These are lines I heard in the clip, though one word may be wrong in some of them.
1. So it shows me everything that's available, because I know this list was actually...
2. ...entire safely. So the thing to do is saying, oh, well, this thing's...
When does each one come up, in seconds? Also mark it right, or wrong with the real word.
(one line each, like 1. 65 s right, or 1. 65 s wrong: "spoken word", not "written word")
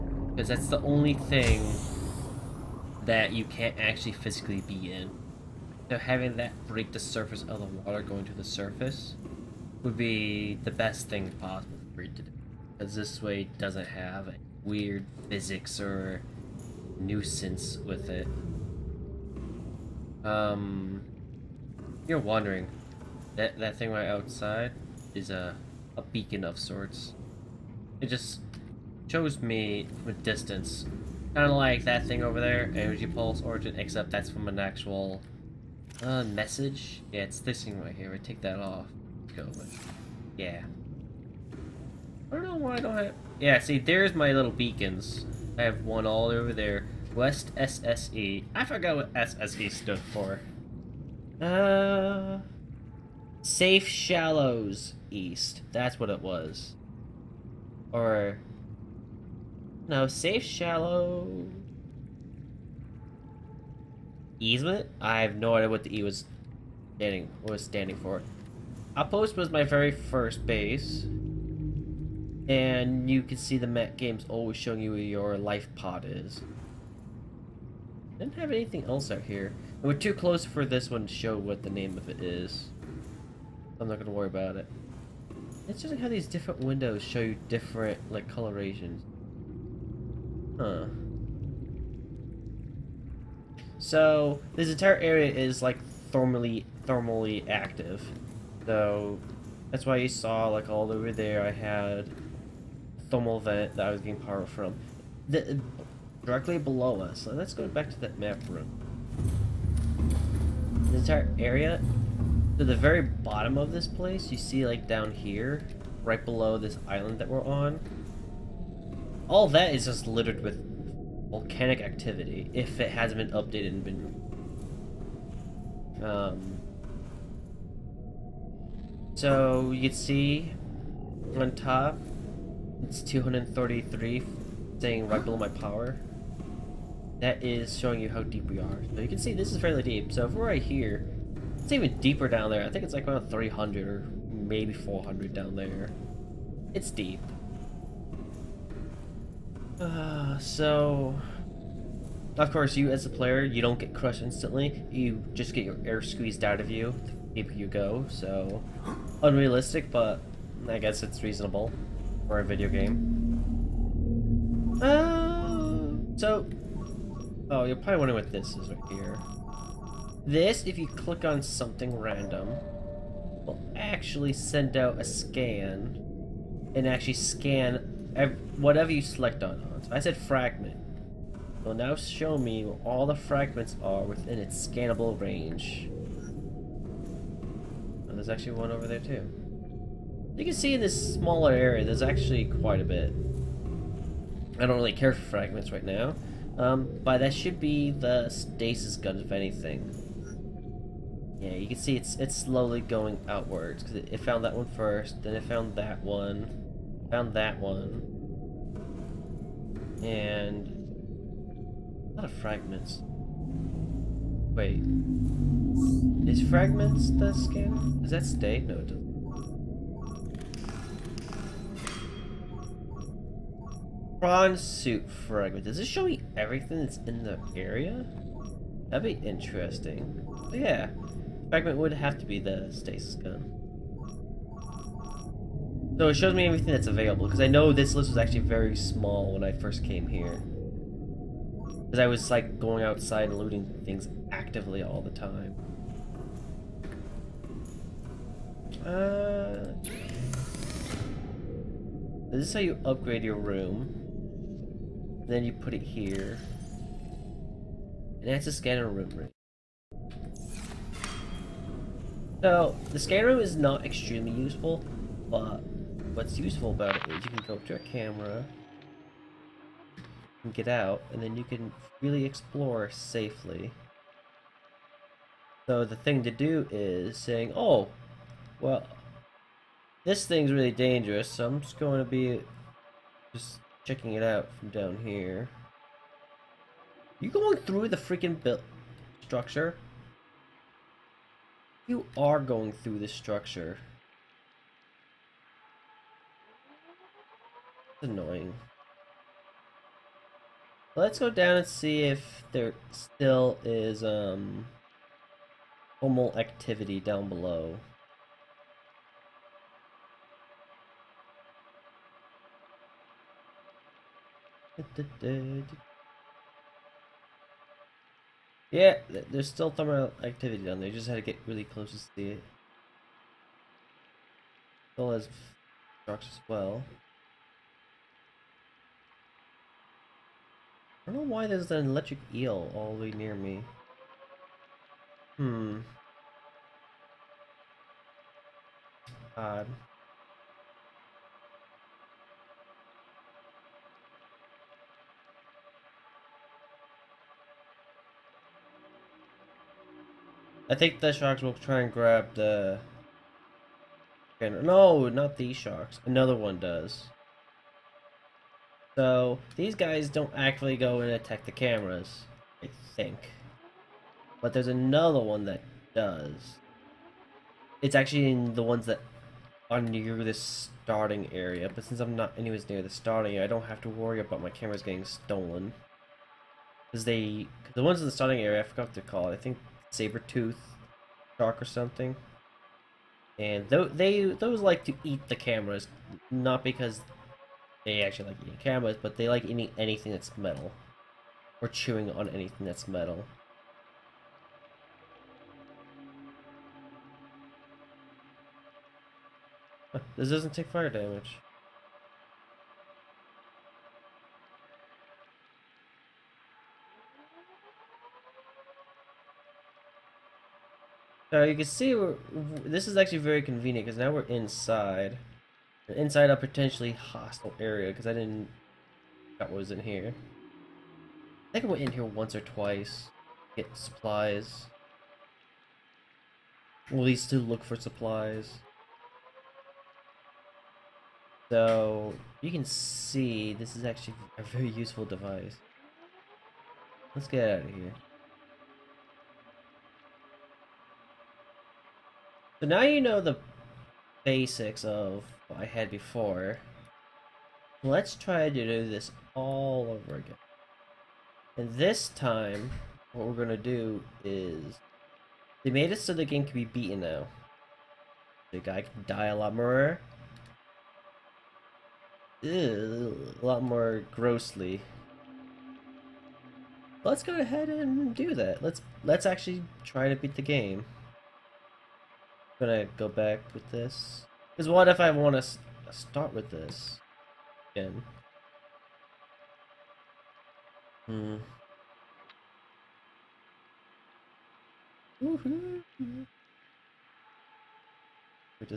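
1. 235 s right
2. 272 s wrong: "explore", not "entire".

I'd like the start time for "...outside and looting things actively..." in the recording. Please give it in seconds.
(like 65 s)
242 s.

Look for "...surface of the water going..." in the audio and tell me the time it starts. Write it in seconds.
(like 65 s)
7 s.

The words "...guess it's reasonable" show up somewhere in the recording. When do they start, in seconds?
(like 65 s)
160 s.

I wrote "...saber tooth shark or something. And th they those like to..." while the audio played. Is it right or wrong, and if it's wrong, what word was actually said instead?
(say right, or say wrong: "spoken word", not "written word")
right.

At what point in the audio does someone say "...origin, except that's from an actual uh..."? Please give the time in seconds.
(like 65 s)
33 s.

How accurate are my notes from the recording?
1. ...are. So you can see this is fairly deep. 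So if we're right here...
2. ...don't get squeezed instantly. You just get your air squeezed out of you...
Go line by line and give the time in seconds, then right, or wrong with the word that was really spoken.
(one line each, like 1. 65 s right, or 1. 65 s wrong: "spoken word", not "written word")
1. 138 s right
2. 153 s wrong: "crushed", not "squeezed".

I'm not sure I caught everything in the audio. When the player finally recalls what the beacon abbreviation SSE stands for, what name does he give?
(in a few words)
Safe Shallows East.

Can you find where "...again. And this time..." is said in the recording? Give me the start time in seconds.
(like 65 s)
450 s.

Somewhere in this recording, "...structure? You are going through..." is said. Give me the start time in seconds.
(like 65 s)
289 s.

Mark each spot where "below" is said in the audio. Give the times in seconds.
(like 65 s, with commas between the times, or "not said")
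106 s, 116 s, 135 s, 307 s.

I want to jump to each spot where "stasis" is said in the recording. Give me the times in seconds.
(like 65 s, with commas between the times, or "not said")
198 s, 232 s.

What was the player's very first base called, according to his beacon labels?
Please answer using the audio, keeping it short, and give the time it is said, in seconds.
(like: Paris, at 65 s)
Outpost, at 68 s.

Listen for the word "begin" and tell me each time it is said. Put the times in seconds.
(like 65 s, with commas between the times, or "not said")
not said.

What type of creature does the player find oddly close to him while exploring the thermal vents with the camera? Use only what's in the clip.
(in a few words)
electric eel.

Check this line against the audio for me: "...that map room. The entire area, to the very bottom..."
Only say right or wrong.
right.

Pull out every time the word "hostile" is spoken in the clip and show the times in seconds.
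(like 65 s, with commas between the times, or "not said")
416 s.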